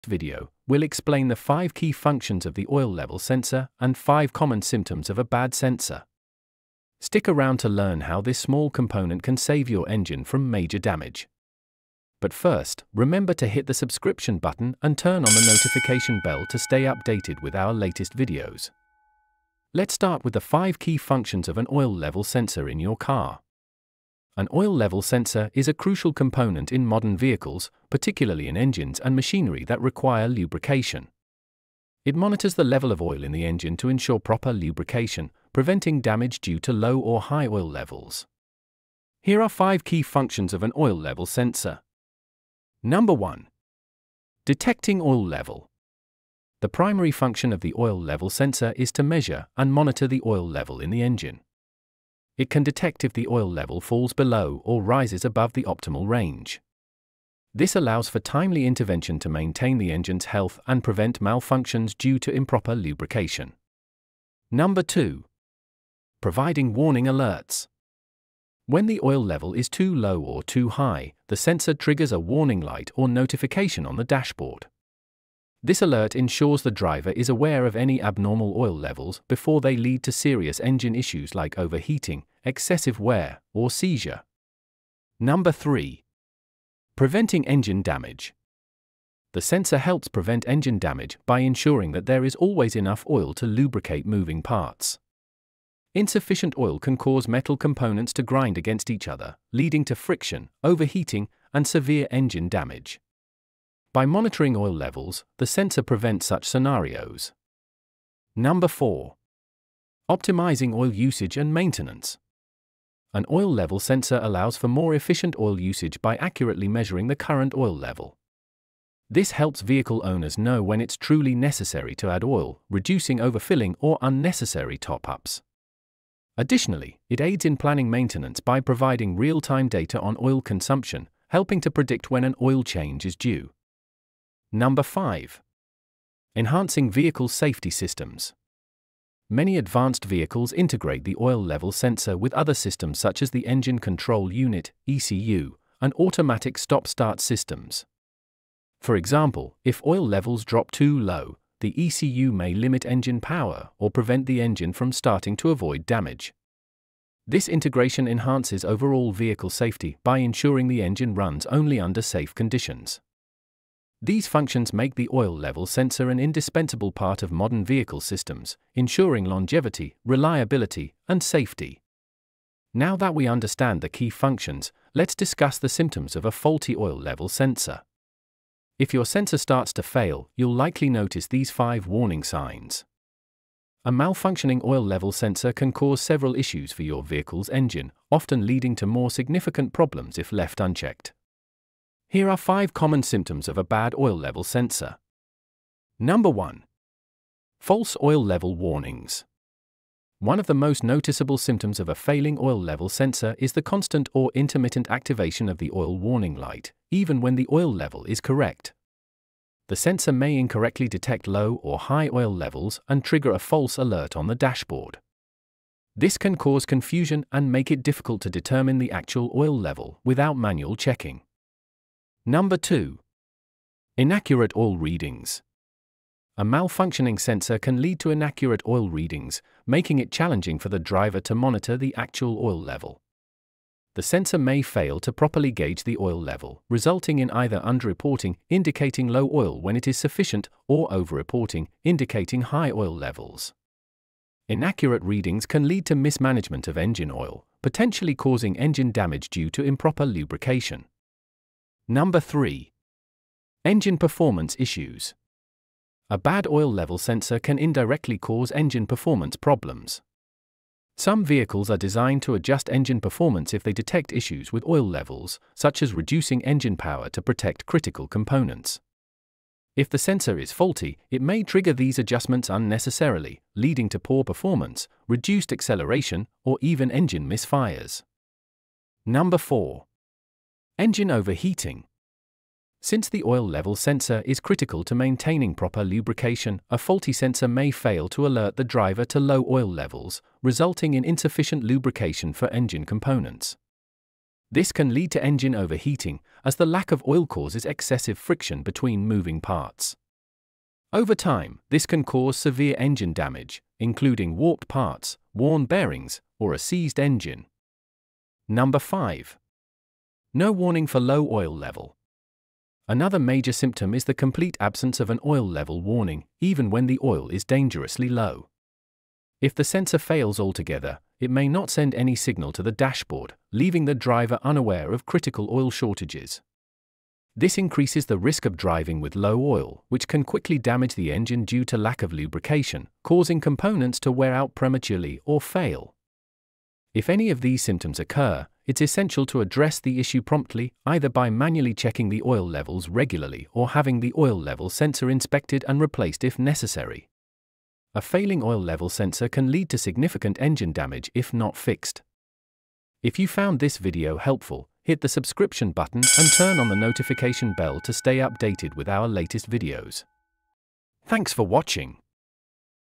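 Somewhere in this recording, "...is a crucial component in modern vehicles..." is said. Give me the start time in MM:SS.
00:25.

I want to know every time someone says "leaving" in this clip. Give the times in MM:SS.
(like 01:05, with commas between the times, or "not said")
05:23.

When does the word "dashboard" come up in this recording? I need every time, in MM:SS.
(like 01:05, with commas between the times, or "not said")
01:14, 03:34, 05:22.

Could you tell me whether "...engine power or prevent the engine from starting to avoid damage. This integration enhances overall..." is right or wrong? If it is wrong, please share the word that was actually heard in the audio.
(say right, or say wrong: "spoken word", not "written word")
right.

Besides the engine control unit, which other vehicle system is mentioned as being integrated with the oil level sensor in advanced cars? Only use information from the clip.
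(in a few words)
automatic stop-start systems.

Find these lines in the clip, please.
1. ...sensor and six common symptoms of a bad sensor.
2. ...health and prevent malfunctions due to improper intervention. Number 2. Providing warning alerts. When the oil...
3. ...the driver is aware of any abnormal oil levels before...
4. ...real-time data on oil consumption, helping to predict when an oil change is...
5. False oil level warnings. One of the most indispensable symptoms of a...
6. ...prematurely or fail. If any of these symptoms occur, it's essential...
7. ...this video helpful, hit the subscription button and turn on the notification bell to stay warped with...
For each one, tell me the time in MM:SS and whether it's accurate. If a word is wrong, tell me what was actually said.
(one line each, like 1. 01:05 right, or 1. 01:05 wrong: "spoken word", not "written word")
1. 00:03 wrong: "five", not "six"
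2. 01:00 wrong: "lubrication", not "intervention"
3. 01:16 right
4. 02:09 right
5. 03:17 wrong: "noticeable", not "indispensable"
6. 05:34 right
7. 05:53 wrong: "updated", not "warped".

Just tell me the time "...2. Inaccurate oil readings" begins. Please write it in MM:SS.
03:42.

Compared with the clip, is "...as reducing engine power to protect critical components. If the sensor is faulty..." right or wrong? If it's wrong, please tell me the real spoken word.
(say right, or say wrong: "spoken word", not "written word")
right.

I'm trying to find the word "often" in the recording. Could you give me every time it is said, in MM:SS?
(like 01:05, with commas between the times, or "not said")
03:08.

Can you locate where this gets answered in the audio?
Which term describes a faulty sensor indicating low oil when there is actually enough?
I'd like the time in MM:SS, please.
03:57.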